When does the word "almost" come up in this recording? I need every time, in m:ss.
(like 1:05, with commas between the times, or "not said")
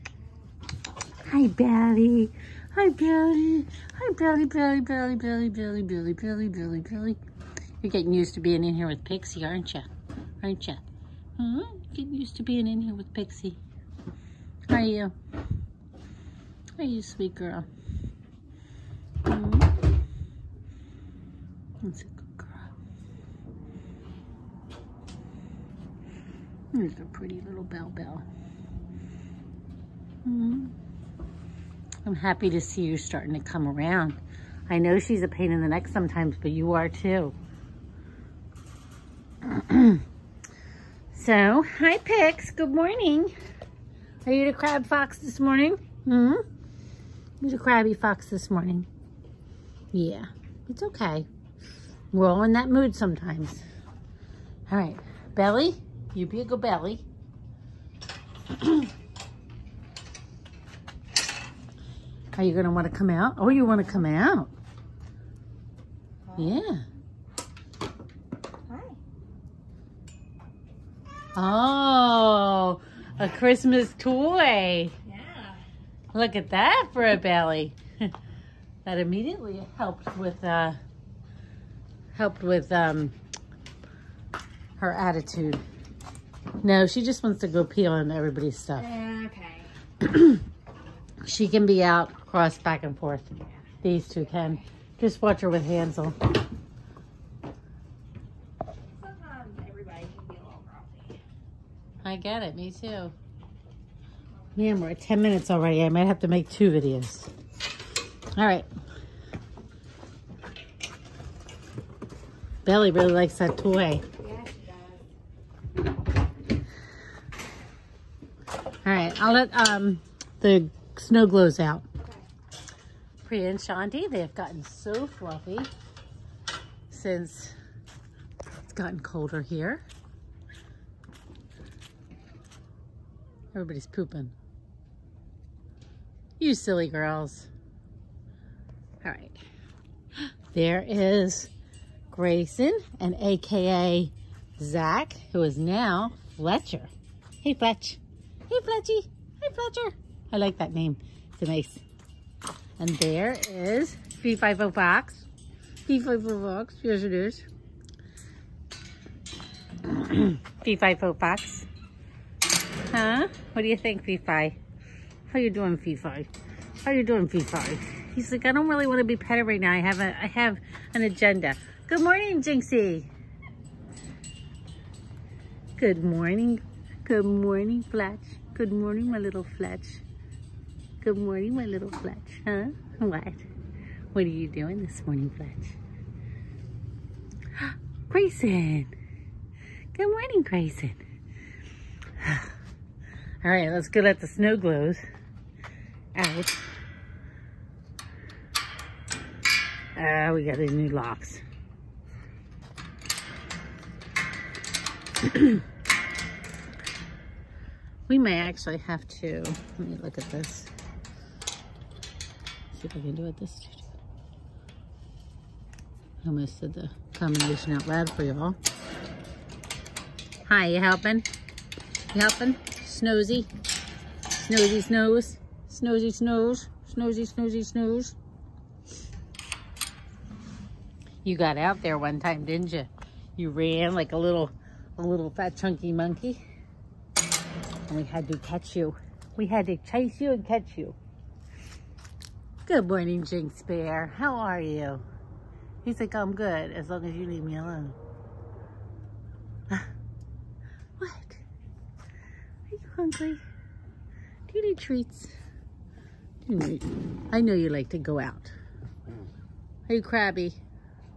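3:36.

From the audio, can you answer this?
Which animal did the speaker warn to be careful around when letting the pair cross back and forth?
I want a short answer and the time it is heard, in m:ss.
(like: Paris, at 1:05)
Hansel, at 1:35.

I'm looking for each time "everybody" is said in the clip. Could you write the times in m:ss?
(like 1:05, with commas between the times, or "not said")
1:28, 2:13.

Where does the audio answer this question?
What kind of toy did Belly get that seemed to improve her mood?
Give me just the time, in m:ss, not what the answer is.
1:13.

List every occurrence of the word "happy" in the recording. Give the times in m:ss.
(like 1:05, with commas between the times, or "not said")
0:32.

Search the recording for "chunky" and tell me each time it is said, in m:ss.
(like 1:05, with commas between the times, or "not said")
3:55.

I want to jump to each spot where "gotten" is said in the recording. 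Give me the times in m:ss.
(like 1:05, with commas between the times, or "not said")
2:04, 2:08.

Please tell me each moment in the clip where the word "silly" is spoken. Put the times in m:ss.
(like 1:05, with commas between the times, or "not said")
2:16.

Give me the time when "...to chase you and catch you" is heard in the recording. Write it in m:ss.
3:59.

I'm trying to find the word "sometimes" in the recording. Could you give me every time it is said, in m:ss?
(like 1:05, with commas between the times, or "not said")
0:35, 0:52.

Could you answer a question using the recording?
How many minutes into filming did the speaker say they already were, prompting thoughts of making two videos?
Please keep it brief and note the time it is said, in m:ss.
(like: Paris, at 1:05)
10, at 1:44.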